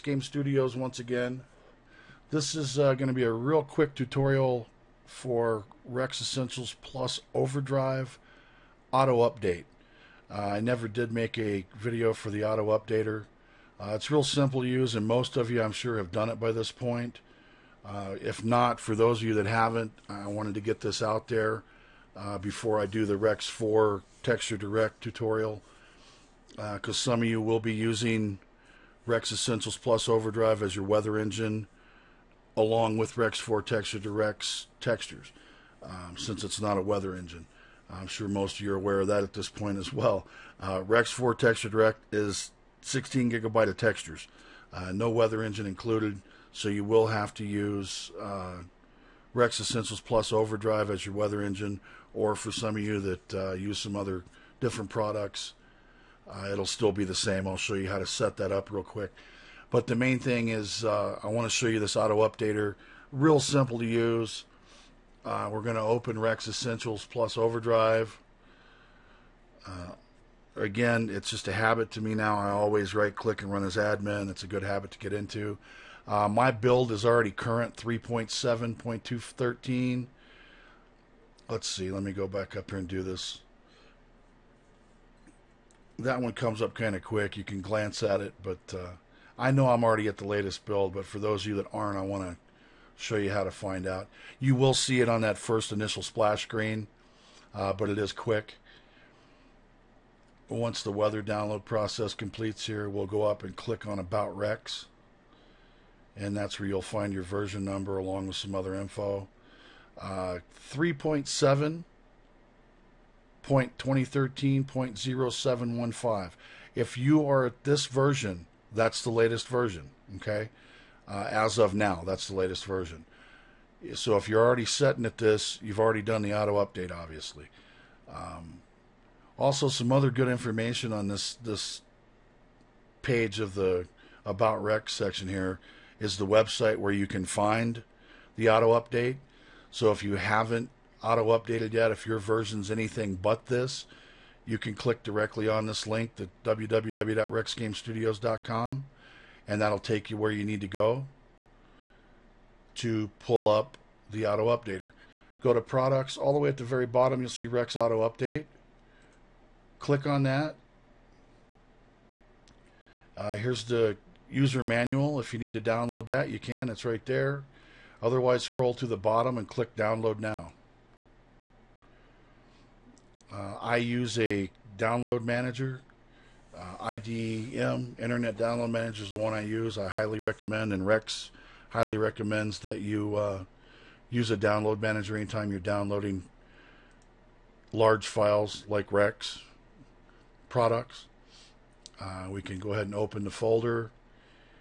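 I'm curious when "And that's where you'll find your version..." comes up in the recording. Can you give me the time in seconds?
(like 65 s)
106 s.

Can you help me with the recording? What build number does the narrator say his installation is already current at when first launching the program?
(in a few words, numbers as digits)
3.7.213.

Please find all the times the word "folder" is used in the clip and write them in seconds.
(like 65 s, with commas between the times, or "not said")
193 s.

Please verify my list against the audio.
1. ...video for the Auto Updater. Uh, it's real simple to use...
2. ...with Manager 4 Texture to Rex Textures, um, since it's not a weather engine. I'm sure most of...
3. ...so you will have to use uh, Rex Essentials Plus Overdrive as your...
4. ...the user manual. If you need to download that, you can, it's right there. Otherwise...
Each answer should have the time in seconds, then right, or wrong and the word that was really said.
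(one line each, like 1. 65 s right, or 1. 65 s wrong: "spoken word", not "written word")
1. 11 s right
2. 32 s wrong: "Rex", not "Manager"
3. 46 s right
4. 163 s right.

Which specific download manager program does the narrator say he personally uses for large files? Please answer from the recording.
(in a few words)
Internet Download Manager.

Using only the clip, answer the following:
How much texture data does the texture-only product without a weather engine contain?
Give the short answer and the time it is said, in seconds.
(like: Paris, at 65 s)
16 gigabytes, at 42 s.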